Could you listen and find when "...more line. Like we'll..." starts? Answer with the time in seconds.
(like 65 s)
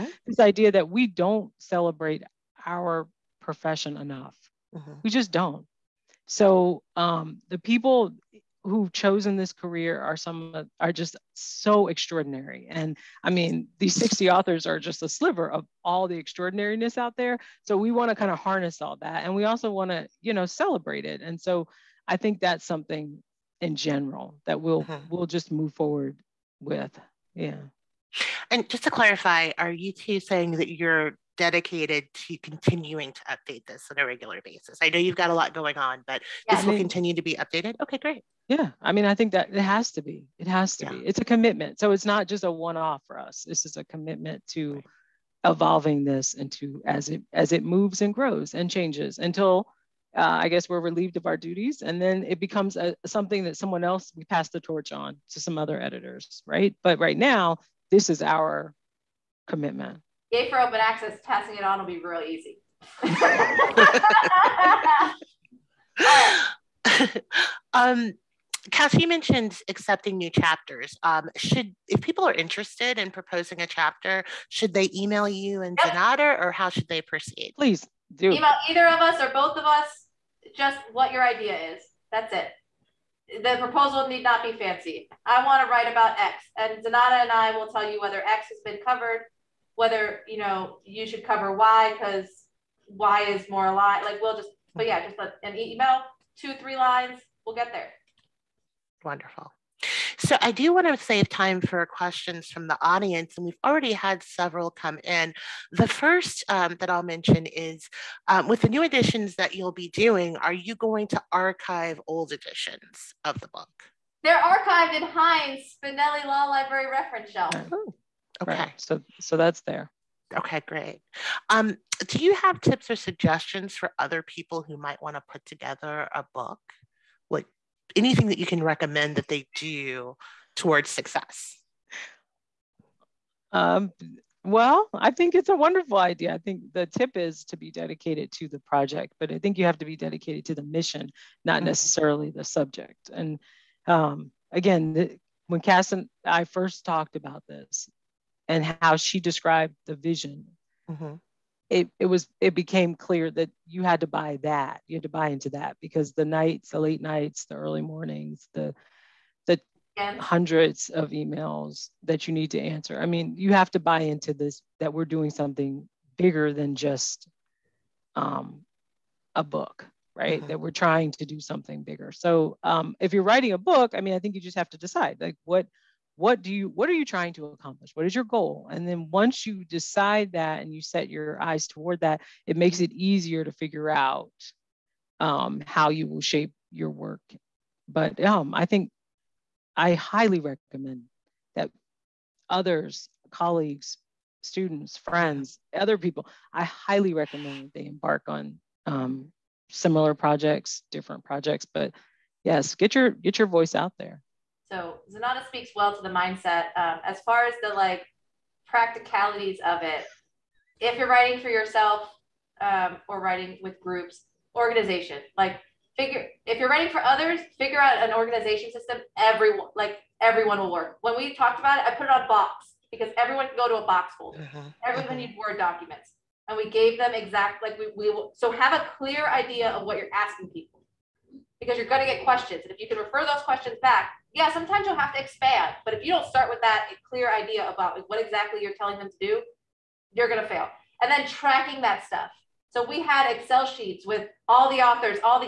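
93 s.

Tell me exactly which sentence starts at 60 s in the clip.
Gay for open access, passing it on will be real easy.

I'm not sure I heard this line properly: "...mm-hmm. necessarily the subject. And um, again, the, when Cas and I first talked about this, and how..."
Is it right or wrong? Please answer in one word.
right.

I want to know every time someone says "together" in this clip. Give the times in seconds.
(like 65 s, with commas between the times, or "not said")
125 s.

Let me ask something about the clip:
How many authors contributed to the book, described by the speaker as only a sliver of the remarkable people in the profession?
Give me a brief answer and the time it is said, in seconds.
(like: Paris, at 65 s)
60, at 13 s.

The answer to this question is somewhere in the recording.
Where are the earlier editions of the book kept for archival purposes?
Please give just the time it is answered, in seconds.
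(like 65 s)
115 s.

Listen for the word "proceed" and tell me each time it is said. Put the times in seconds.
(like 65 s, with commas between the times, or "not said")
77 s.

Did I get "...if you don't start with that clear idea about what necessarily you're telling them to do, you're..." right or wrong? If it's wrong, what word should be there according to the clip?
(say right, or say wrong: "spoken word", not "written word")
wrong: "exactly", not "necessarily".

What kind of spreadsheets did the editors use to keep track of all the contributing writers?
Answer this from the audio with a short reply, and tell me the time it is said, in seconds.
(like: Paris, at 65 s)
Excel, at 243 s.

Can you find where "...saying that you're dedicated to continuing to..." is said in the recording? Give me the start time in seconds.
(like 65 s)
30 s.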